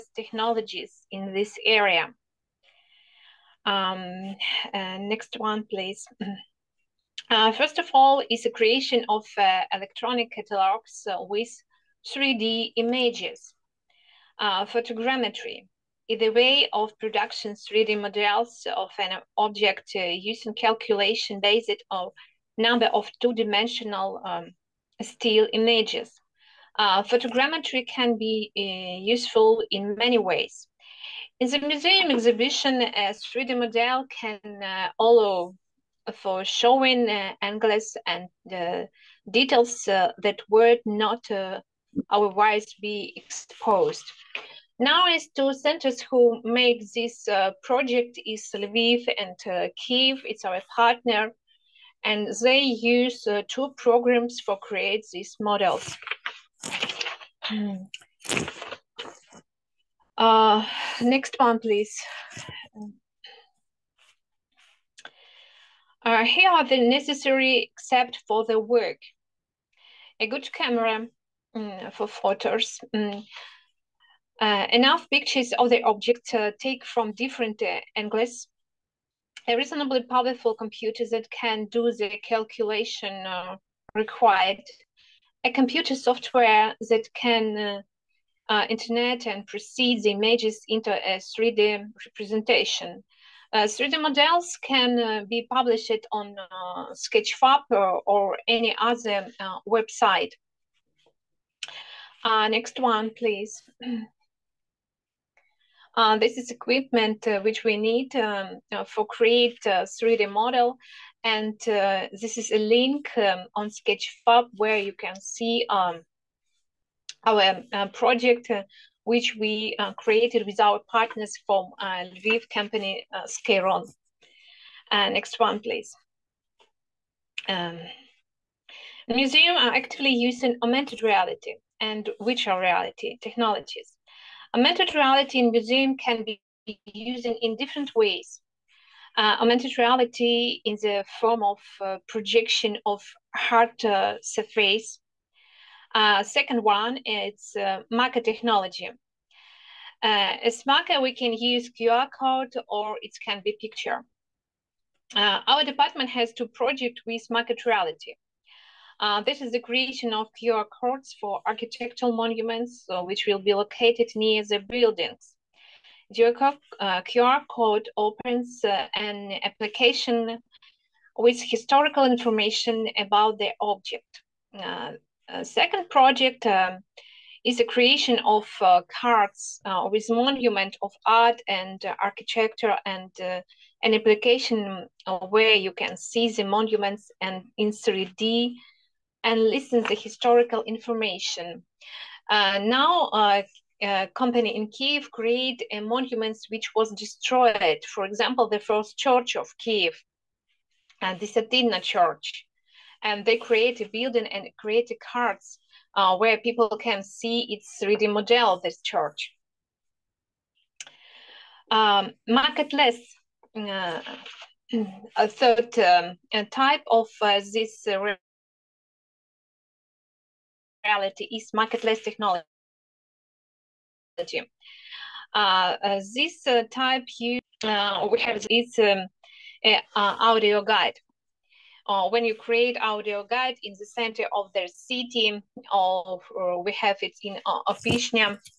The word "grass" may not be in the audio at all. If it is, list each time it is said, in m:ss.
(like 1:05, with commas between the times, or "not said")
not said.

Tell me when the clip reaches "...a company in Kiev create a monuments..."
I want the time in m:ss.
3:13.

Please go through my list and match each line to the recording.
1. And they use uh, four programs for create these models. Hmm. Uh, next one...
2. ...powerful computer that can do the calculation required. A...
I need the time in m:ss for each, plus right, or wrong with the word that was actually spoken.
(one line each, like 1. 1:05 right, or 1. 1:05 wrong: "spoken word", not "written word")
1. 0:52 wrong: "two", not "four"
2. 1:20 right.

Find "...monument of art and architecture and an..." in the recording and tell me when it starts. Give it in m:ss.
3:00.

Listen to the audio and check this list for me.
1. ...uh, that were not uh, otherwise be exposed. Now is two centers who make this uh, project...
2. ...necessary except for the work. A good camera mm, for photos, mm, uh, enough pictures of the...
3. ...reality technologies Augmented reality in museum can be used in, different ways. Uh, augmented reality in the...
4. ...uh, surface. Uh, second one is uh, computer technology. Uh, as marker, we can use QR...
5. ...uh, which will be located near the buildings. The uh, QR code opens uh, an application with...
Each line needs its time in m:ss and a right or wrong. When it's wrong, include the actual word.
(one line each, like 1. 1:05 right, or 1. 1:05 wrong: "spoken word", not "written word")
1. 0:39 right
2. 1:06 right
3. 2:12 right
4. 2:23 wrong: "marker", not "computer"
5. 2:42 right.